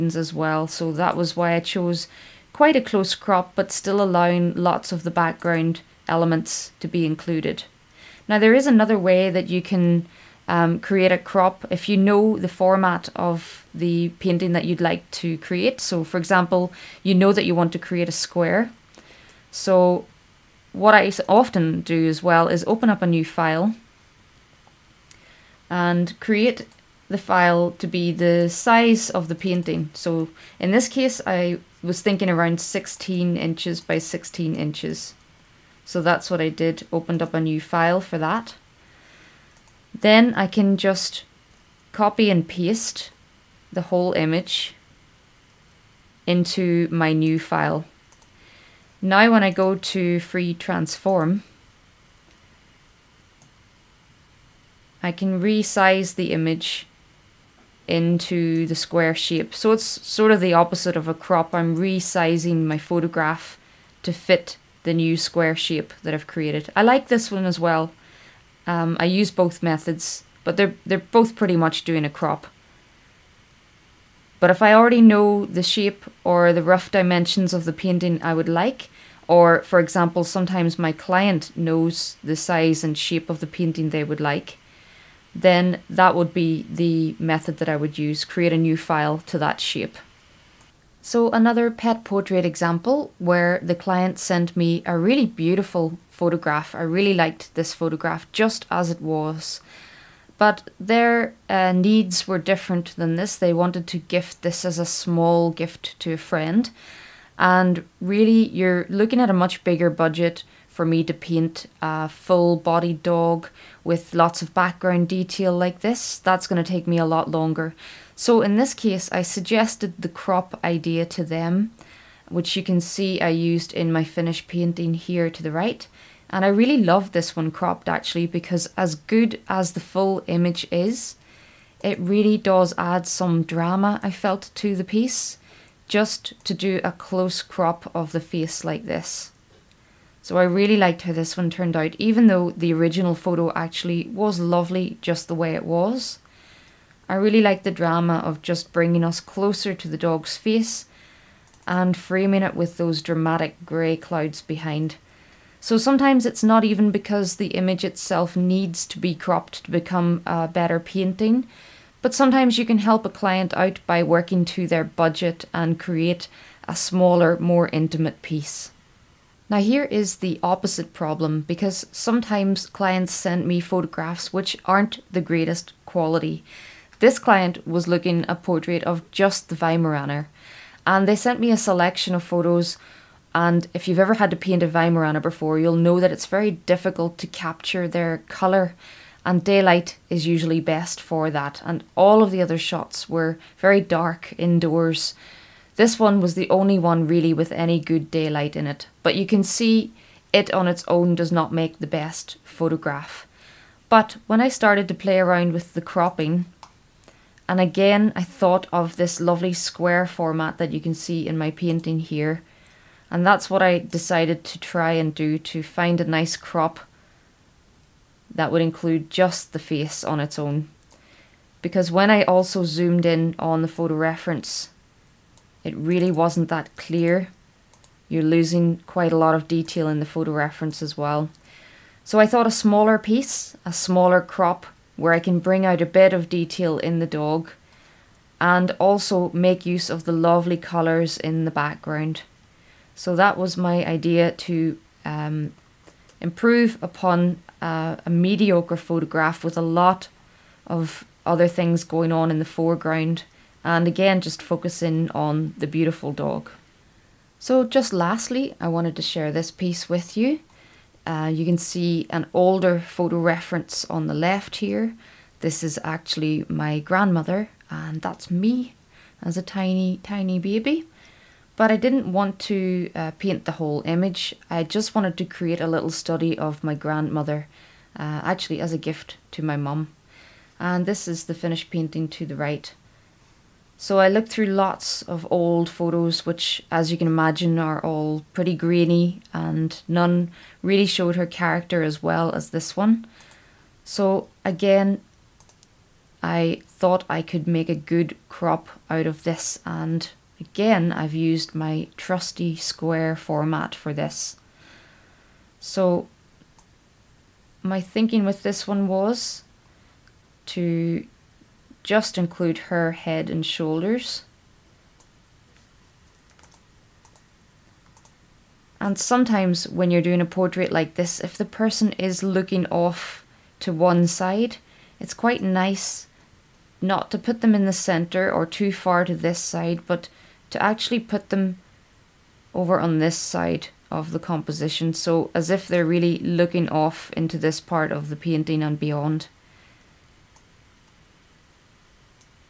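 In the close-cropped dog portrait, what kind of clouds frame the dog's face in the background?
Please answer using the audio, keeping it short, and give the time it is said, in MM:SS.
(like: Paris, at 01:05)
dramatic grey clouds, at 02:33.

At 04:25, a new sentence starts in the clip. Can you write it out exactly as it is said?
This is actually my grandmother and that's me as a tiny, tiny baby.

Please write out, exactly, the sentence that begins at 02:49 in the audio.
Now, here is the opposite problem because sometimes clients send me photographs which aren't the greatest quality.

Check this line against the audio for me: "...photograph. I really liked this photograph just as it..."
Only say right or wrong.
right.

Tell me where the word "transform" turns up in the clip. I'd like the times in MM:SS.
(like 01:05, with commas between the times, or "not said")
00:50.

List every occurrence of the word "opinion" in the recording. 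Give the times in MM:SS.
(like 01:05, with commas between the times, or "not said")
not said.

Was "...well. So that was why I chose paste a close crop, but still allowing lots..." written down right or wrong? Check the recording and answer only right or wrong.
wrong.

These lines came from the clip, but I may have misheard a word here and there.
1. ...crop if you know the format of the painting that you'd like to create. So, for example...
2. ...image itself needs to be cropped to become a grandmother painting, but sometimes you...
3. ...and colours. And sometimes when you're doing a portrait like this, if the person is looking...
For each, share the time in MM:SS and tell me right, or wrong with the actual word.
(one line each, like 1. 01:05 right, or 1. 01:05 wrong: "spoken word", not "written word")
1. 00:11 right
2. 02:37 wrong: "better", not "grandmother"
3. 05:13 wrong: "shoulders", not "colours".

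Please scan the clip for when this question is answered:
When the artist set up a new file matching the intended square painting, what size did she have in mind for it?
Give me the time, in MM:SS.
00:32.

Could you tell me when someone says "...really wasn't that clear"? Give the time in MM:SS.
03:45.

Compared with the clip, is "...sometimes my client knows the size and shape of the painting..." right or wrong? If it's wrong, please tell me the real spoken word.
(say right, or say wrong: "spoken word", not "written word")
right.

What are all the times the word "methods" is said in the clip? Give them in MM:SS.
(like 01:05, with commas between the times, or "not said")
01:09, 01:27.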